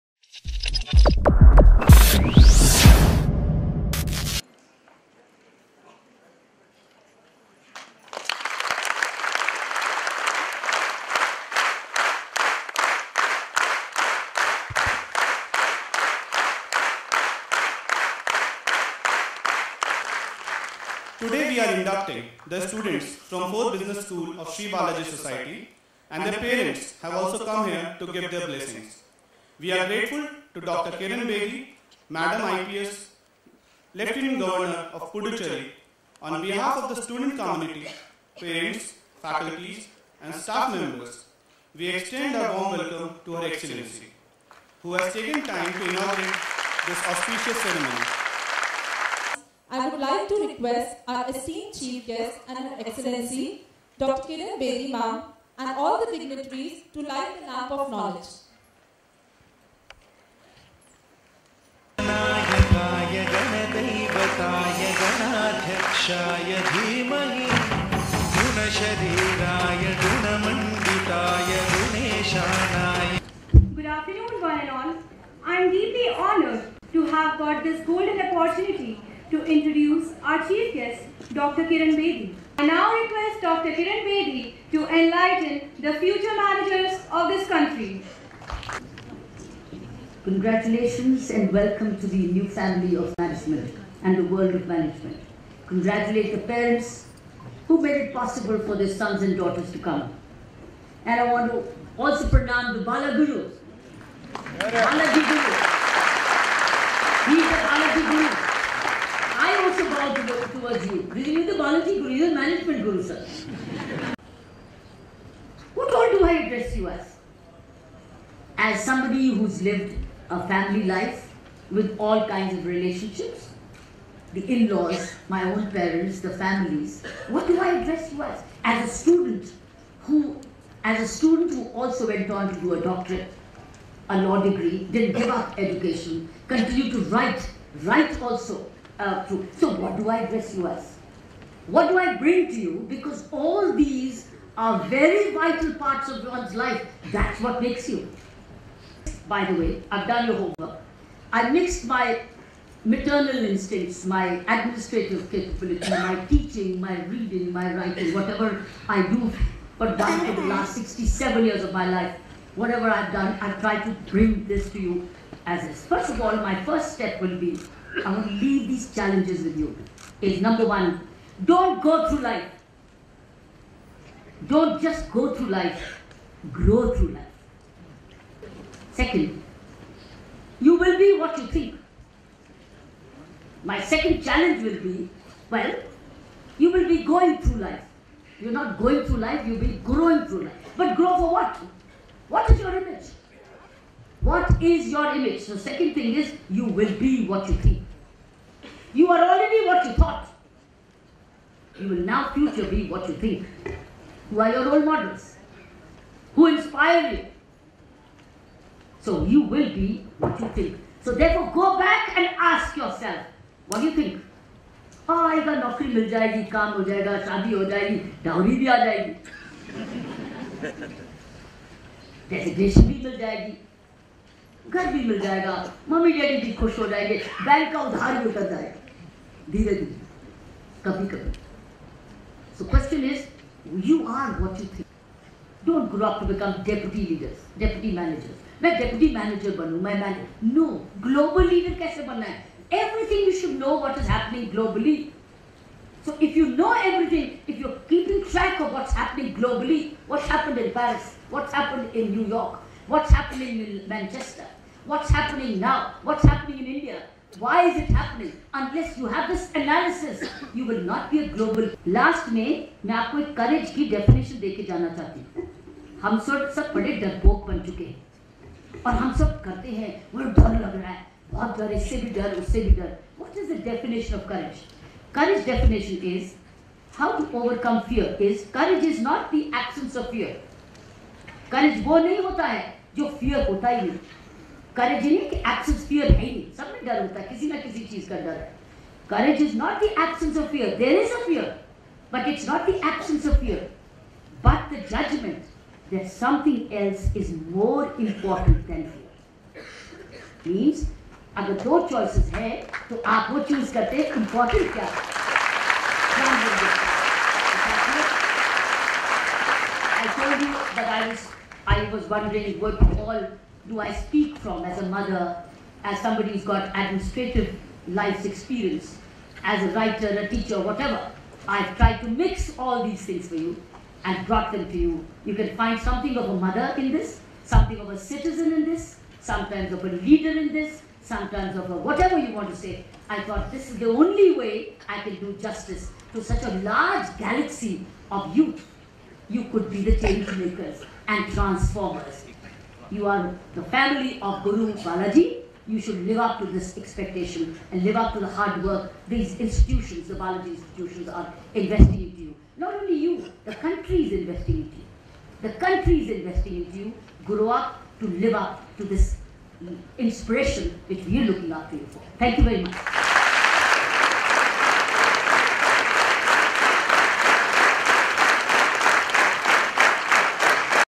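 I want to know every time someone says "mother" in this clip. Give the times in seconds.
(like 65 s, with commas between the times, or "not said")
314 s, 326 s.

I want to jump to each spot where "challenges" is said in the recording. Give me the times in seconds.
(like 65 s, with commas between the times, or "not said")
168 s, 184 s.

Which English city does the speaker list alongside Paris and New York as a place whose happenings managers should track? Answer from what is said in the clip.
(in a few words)
Manchester.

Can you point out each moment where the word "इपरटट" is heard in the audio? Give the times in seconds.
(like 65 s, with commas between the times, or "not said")
298 s, 304 s.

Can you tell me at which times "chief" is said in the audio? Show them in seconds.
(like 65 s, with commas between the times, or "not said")
51 s, 80 s.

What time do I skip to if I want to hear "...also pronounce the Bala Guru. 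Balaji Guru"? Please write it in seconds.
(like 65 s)
101 s.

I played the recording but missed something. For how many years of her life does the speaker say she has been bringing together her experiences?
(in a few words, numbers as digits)
67.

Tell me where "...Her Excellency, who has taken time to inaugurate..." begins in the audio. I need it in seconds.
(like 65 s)
43 s.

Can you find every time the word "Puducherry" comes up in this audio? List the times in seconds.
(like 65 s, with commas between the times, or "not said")
35 s.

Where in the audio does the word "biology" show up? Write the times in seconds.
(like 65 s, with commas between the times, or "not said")
111 s.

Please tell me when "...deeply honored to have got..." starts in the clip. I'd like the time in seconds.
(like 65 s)
75 s.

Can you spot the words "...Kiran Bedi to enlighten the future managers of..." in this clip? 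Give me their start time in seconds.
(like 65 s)
83 s.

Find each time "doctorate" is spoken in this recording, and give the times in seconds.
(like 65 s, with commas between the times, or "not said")
132 s.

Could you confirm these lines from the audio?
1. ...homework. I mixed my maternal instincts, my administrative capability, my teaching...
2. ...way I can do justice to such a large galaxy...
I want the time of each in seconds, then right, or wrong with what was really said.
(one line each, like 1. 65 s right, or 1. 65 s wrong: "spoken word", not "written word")
1. 150 s right
2. 334 s right.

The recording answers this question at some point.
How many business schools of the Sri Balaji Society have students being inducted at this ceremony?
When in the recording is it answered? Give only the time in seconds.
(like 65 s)
23 s.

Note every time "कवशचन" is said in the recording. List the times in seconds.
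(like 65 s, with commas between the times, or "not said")
232 s.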